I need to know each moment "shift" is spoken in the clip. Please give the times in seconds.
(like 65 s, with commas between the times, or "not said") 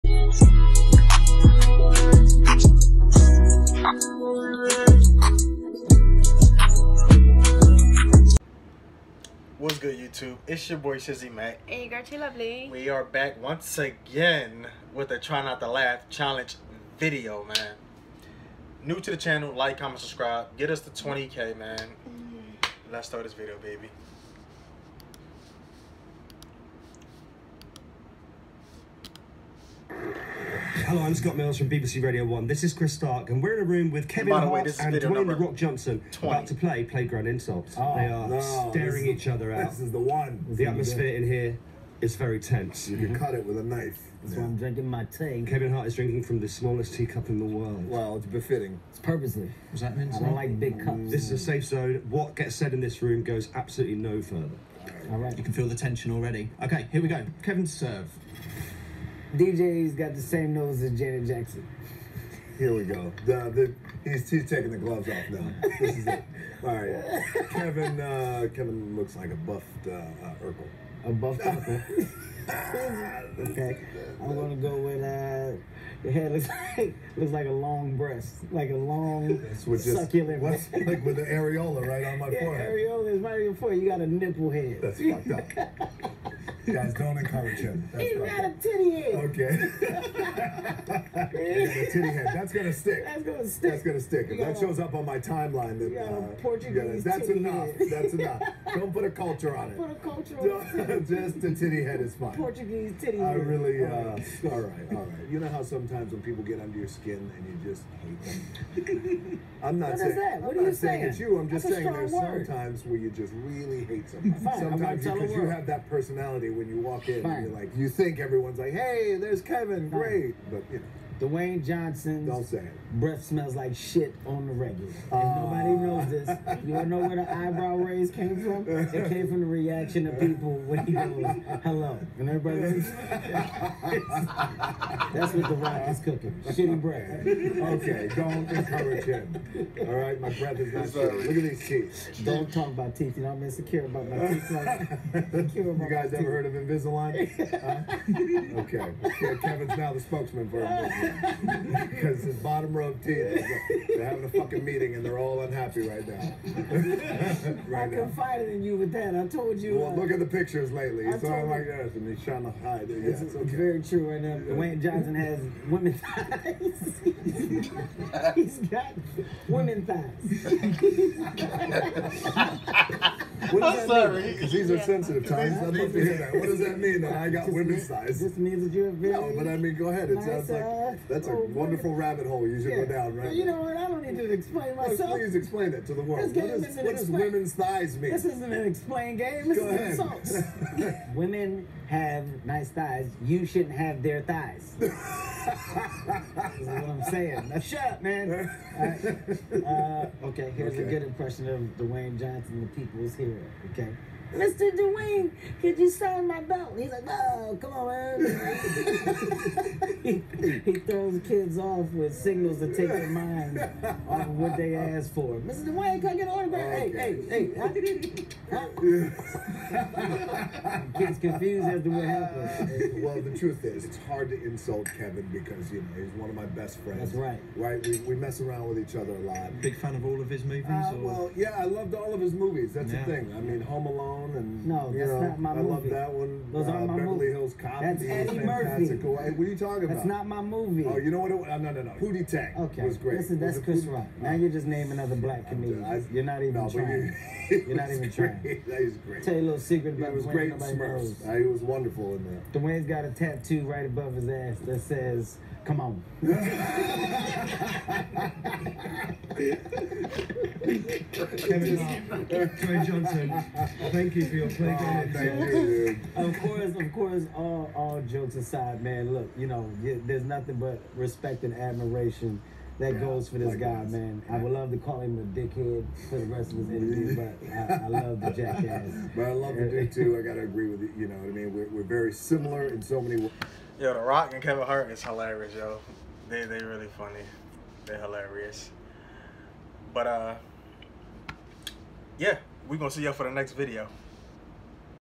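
not said.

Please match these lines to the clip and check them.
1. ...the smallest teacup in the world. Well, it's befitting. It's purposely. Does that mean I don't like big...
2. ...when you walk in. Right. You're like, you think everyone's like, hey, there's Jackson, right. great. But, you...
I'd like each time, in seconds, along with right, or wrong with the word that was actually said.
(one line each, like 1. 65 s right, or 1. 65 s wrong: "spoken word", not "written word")
1. 46 s right
2. 116 s wrong: "Kevin", not "Jackson".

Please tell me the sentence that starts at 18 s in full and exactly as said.
New to the channel, like, comment, subscribe.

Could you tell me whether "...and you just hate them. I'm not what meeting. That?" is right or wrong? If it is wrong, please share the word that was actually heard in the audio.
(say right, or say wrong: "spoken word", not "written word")
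wrong: "saying", not "meeting".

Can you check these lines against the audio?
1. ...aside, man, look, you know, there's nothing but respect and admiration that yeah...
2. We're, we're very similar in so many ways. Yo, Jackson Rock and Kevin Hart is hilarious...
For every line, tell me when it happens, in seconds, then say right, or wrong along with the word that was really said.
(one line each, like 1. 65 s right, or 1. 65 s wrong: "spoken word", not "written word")
1. 268 s right
2. 281 s wrong: "The", not "Jackson".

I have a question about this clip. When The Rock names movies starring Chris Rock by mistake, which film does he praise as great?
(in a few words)
Pootie Tang.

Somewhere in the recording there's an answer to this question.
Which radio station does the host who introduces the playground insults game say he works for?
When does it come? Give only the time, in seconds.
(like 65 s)
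31 s.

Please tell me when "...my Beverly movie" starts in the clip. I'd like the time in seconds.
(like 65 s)
236 s.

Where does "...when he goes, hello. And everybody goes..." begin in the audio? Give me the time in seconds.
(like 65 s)
130 s.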